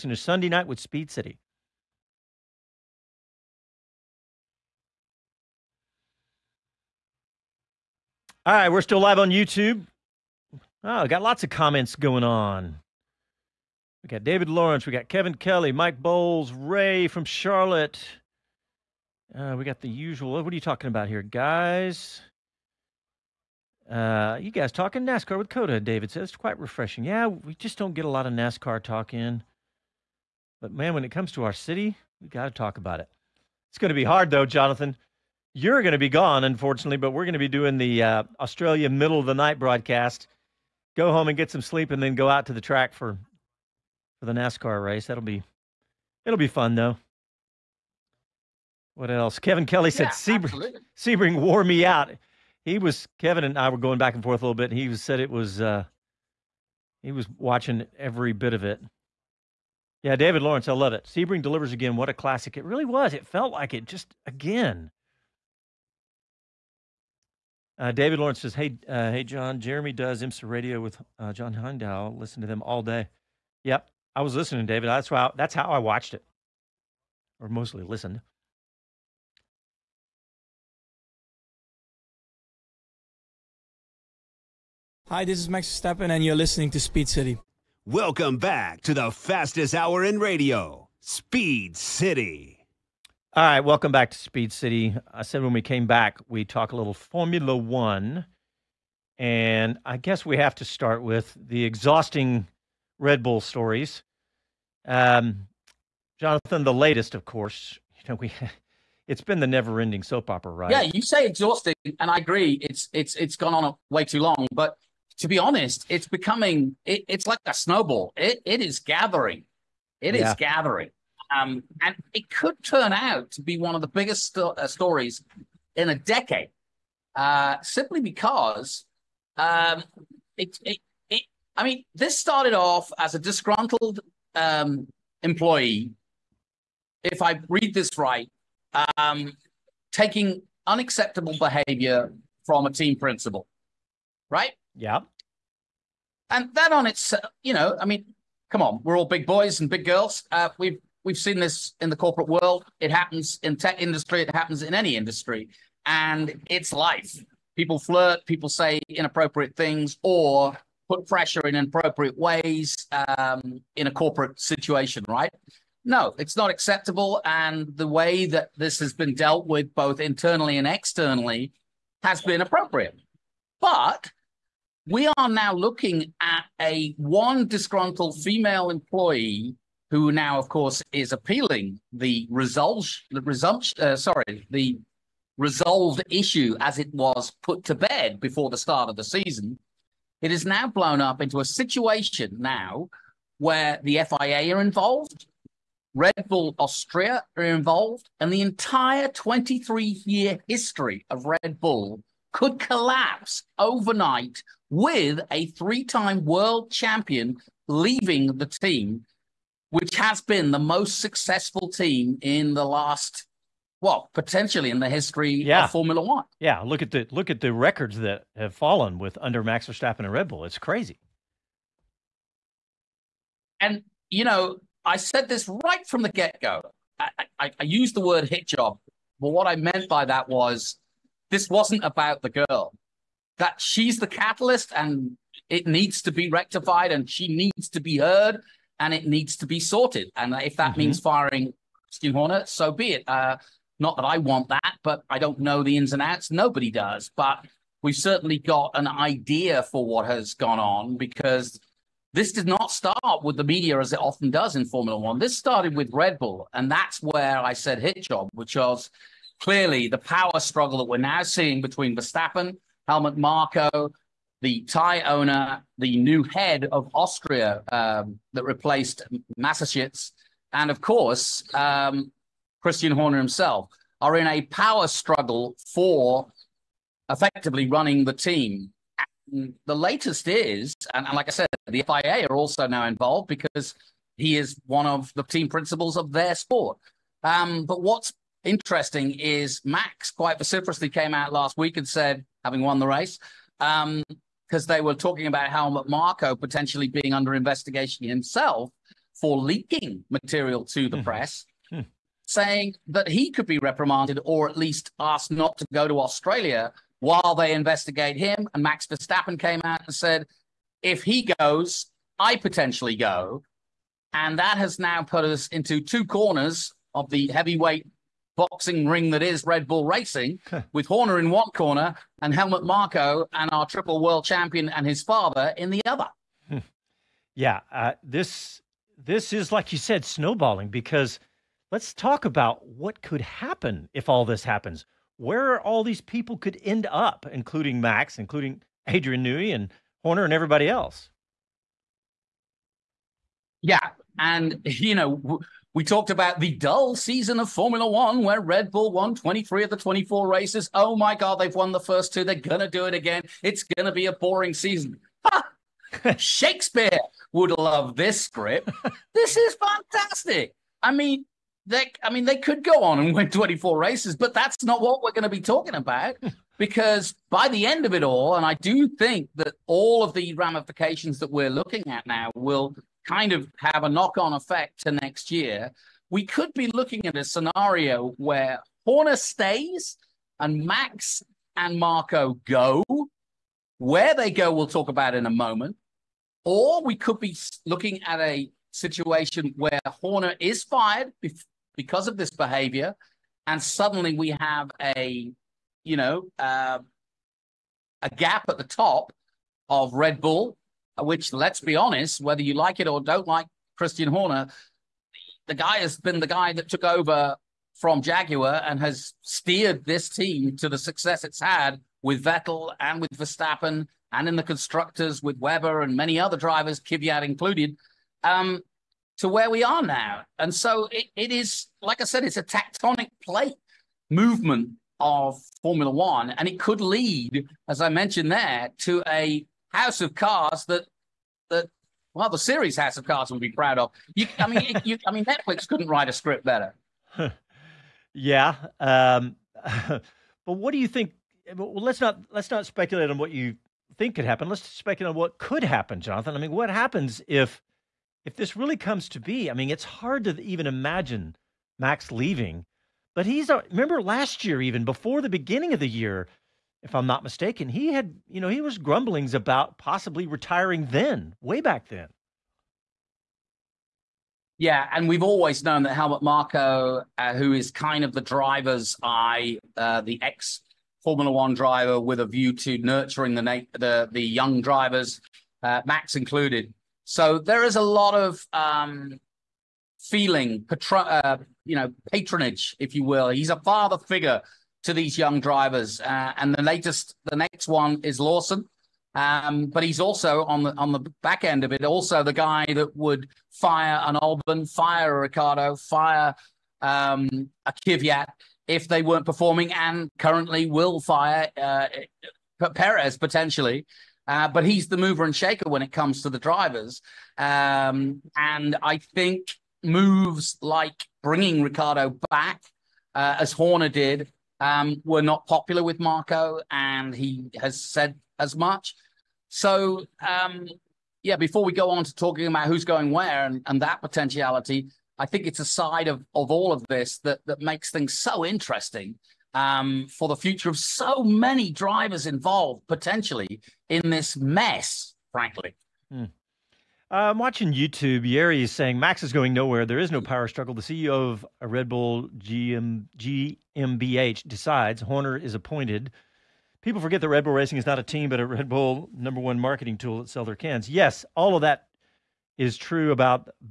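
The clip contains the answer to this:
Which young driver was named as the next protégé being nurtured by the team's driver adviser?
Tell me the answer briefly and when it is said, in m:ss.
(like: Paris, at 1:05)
Lawson, at 8:08.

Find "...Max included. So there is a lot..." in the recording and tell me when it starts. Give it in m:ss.
7:55.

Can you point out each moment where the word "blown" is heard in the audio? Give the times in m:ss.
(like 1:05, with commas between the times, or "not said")
3:10.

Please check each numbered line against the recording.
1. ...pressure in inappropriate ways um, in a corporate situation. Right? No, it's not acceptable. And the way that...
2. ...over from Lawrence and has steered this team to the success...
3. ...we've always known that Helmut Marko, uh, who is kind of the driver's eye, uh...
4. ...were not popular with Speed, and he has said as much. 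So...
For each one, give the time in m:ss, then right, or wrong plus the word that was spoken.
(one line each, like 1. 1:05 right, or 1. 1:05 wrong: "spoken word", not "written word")
1. 2:41 right
2. 6:46 wrong: "Jaguar", not "Lawrence"
3. 7:45 right
4. 8:35 wrong: "Marko", not "Speed".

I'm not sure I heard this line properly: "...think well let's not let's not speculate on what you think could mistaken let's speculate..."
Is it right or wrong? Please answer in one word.
wrong.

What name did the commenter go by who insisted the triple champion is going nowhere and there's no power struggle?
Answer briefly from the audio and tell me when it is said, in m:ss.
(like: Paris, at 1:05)
Yeri, at 8:58.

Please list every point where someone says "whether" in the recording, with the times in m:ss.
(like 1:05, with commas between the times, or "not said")
6:42.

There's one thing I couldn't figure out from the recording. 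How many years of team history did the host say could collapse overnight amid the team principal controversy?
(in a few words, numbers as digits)
23.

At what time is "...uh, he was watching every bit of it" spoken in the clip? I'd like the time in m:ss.
0:55.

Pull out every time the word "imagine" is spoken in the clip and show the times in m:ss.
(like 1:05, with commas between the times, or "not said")
7:30.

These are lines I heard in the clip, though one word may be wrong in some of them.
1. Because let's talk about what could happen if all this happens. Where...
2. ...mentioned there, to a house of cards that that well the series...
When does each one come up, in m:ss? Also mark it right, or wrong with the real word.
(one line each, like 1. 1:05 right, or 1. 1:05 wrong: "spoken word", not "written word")
1. 5:30 right
2. 7:07 right.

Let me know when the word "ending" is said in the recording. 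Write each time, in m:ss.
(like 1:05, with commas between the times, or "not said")
1:49.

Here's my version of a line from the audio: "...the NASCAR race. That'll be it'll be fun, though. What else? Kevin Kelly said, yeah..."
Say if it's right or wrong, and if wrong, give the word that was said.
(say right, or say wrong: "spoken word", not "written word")
right.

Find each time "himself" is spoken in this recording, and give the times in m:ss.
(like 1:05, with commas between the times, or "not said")
4:33, 4:58.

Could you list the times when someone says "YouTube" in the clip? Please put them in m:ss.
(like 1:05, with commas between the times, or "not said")
0:09, 8:57.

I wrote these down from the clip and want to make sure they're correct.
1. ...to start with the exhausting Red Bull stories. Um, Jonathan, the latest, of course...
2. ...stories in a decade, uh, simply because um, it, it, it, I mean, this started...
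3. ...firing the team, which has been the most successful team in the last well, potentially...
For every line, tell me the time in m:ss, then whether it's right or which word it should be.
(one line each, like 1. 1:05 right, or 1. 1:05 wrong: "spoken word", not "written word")
1. 1:40 right
2. 2:04 right
3. 3:27 wrong: "leaving", not "firing".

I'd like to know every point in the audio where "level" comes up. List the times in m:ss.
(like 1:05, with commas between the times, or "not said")
not said.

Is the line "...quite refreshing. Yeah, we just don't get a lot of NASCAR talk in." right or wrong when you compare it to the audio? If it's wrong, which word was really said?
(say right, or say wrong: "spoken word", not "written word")
right.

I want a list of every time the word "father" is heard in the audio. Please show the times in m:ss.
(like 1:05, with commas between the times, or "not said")
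5:25, 8:03.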